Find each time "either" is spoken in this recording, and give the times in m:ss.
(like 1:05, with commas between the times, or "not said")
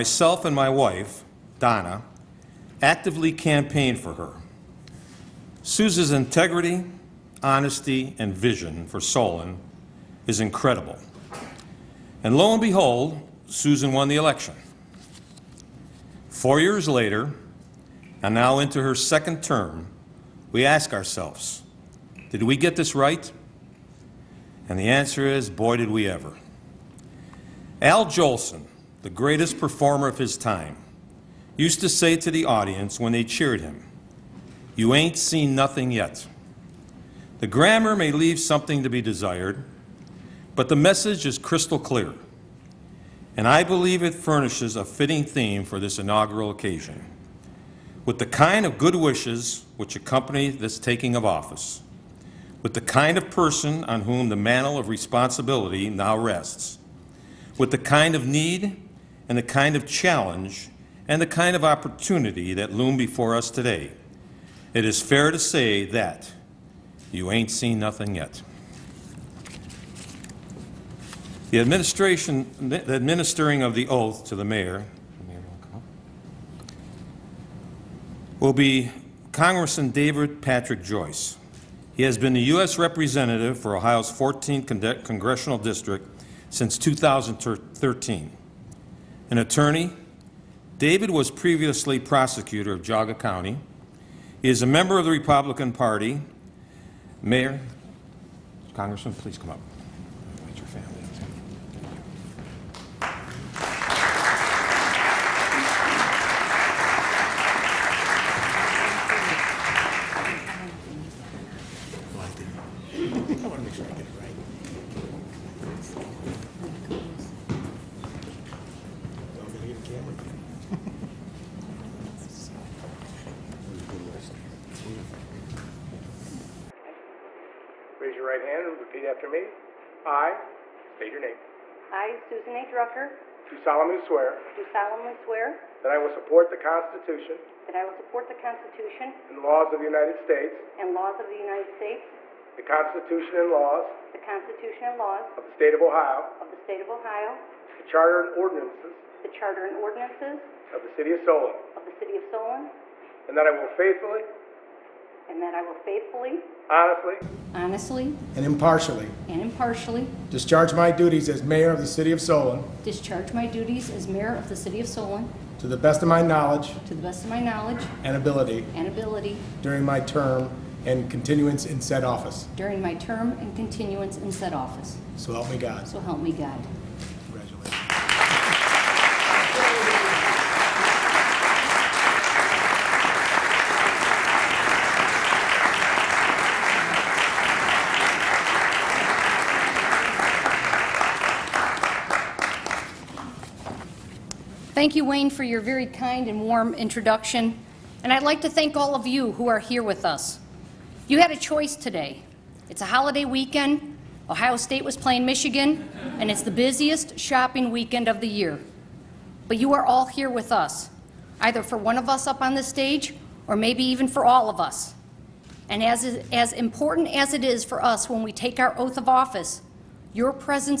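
3:31.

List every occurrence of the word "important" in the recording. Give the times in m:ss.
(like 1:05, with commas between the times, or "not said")
3:36.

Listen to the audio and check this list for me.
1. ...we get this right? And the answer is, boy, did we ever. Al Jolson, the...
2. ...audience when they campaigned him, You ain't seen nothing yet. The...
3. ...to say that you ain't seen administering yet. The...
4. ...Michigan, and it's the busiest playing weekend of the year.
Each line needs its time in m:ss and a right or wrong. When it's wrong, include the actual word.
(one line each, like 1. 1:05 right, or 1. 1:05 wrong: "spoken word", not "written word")
1. 0:22 right
2. 0:32 wrong: "cheered", not "campaigned"
3. 1:05 wrong: "nothing", not "administering"
4. 3:25 wrong: "shopping", not "playing".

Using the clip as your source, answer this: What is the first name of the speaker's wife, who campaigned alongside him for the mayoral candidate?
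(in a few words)
Donna.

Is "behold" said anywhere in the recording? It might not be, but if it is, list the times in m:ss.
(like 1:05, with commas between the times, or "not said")
0:12.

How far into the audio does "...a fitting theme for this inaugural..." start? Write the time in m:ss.
0:44.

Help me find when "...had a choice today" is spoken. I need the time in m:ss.
3:21.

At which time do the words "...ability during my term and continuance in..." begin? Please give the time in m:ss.
2:48.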